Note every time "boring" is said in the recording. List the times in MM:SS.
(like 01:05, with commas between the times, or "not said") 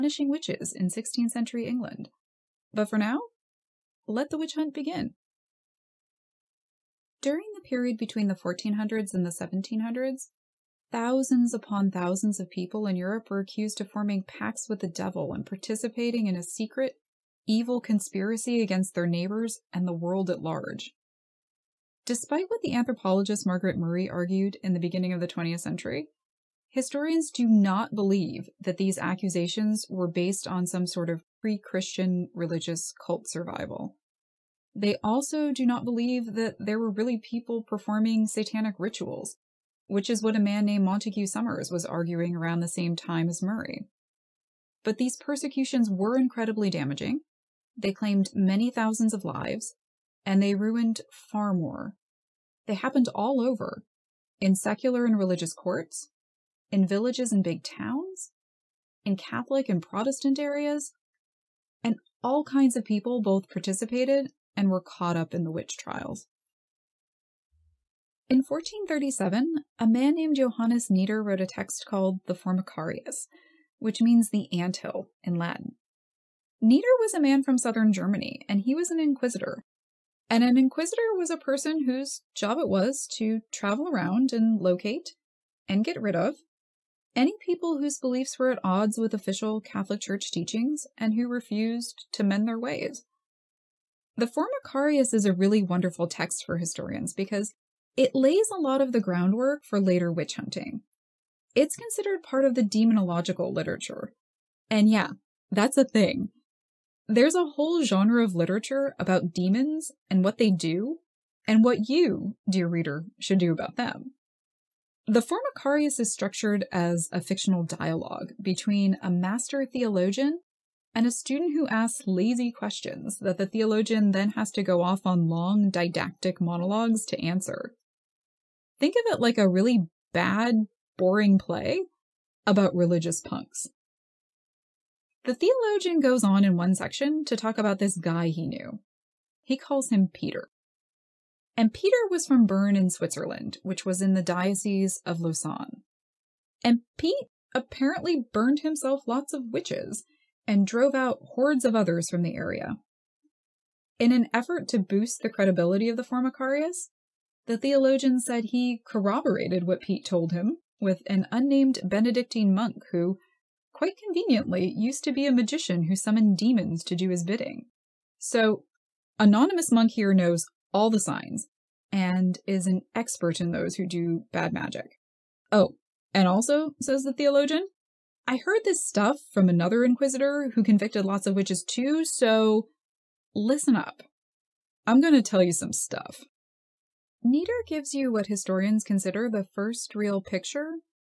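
02:10.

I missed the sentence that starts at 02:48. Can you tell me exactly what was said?
So, Anonymous Monk here knows all the signs and is an expert in those who do bad magic.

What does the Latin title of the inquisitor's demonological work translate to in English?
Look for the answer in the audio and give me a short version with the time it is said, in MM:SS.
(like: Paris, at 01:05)
The anthill, at 01:14.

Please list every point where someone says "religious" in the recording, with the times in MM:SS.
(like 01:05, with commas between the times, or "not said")
00:32, 00:55, 02:12.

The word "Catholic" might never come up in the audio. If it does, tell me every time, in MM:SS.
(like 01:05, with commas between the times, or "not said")
00:59, 01:29.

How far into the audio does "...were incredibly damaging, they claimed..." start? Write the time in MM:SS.
00:45.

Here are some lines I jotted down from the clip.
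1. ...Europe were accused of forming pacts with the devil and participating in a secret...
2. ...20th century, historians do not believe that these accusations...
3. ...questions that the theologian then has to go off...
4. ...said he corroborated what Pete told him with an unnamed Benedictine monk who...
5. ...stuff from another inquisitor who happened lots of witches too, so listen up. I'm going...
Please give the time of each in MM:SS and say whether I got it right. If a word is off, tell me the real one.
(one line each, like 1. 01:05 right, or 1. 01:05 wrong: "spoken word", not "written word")
1. 00:12 right
2. 00:25 right
3. 02:02 right
4. 02:38 right
5. 02:58 wrong: "convicted", not "happened".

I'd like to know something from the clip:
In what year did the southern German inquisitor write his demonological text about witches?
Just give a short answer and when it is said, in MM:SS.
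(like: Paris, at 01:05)
1437, at 01:08.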